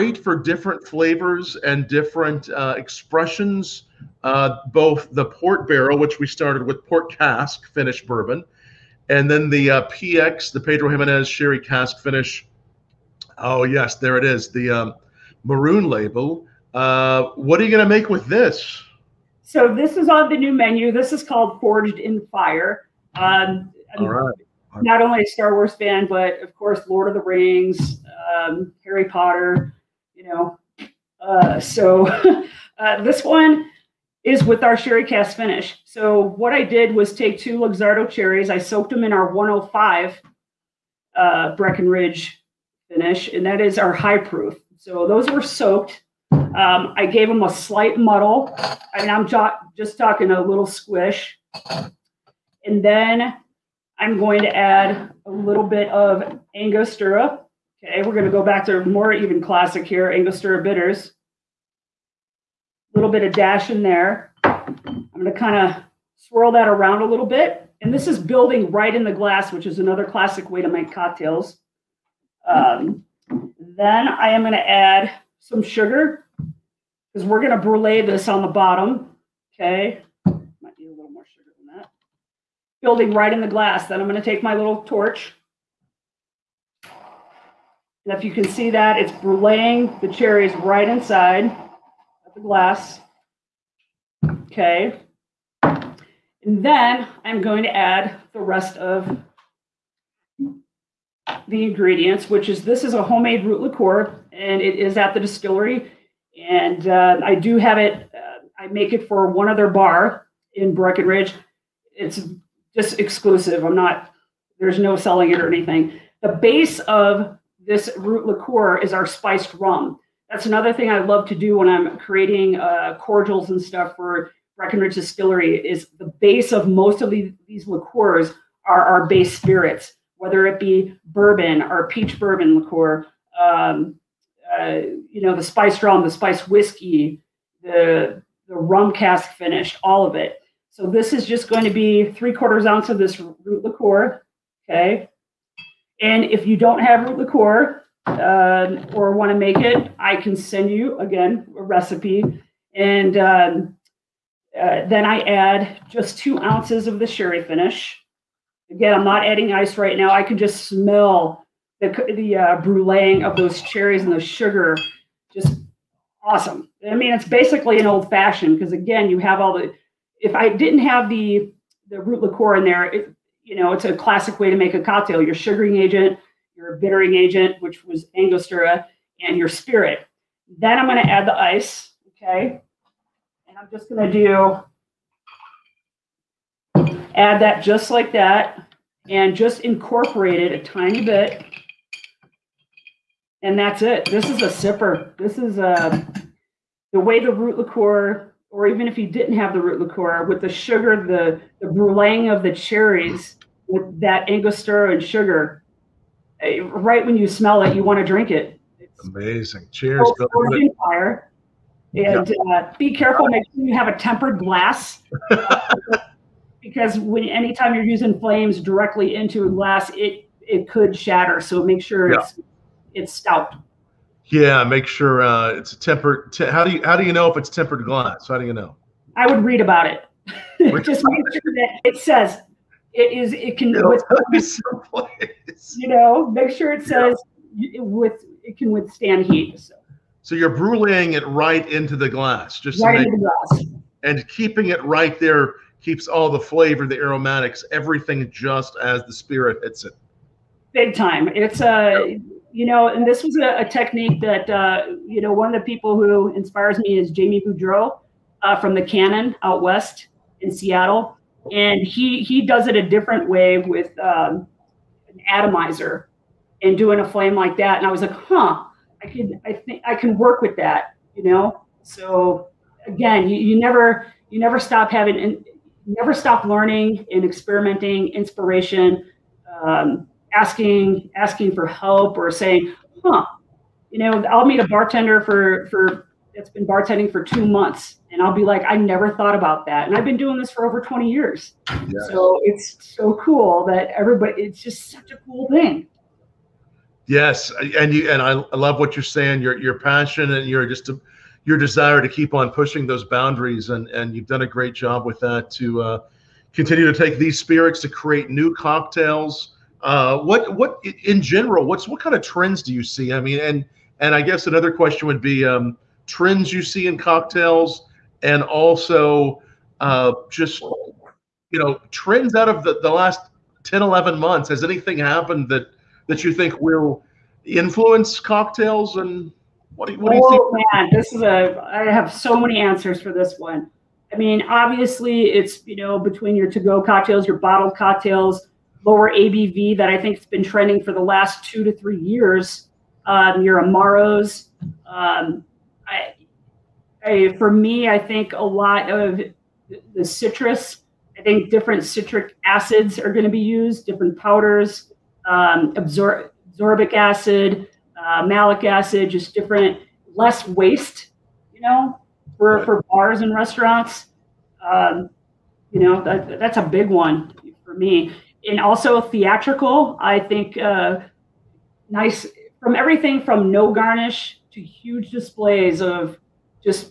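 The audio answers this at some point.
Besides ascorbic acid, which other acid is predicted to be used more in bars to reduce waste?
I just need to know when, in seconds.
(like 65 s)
358 s.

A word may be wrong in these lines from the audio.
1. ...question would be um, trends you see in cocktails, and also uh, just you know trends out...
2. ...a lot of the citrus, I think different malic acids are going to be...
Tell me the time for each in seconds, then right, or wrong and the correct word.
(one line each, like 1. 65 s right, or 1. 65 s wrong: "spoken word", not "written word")
1. 314 s right
2. 348 s wrong: "citric", not "malic".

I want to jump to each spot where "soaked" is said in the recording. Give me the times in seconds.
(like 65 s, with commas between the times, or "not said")
38 s, 45 s.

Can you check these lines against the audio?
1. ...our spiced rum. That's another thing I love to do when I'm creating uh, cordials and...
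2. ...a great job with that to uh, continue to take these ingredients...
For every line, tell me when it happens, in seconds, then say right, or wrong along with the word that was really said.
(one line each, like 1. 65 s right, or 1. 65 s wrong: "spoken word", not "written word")
1. 118 s right
2. 304 s wrong: "spirits", not "ingredients".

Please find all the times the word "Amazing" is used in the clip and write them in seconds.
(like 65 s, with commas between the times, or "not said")
209 s.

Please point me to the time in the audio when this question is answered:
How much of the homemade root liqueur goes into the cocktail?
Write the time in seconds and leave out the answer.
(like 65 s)
142 s.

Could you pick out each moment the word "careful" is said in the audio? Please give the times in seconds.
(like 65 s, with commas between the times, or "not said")
212 s.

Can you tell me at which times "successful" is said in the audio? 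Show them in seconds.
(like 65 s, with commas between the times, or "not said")
not said.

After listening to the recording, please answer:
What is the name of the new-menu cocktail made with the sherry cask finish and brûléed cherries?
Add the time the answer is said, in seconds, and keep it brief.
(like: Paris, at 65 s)
Forged in Fire, at 21 s.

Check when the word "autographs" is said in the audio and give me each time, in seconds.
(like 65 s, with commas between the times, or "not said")
not said.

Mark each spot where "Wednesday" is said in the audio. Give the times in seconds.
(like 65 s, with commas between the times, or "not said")
not said.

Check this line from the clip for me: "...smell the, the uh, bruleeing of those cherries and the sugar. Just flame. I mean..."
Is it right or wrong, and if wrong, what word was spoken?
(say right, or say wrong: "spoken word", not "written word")
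wrong: "awesome", not "flame".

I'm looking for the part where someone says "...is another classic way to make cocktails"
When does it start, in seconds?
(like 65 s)
69 s.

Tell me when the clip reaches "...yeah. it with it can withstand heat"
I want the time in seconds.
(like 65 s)
237 s.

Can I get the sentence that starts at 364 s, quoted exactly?
Um, you know, that, that's a big one for me and also theatrical.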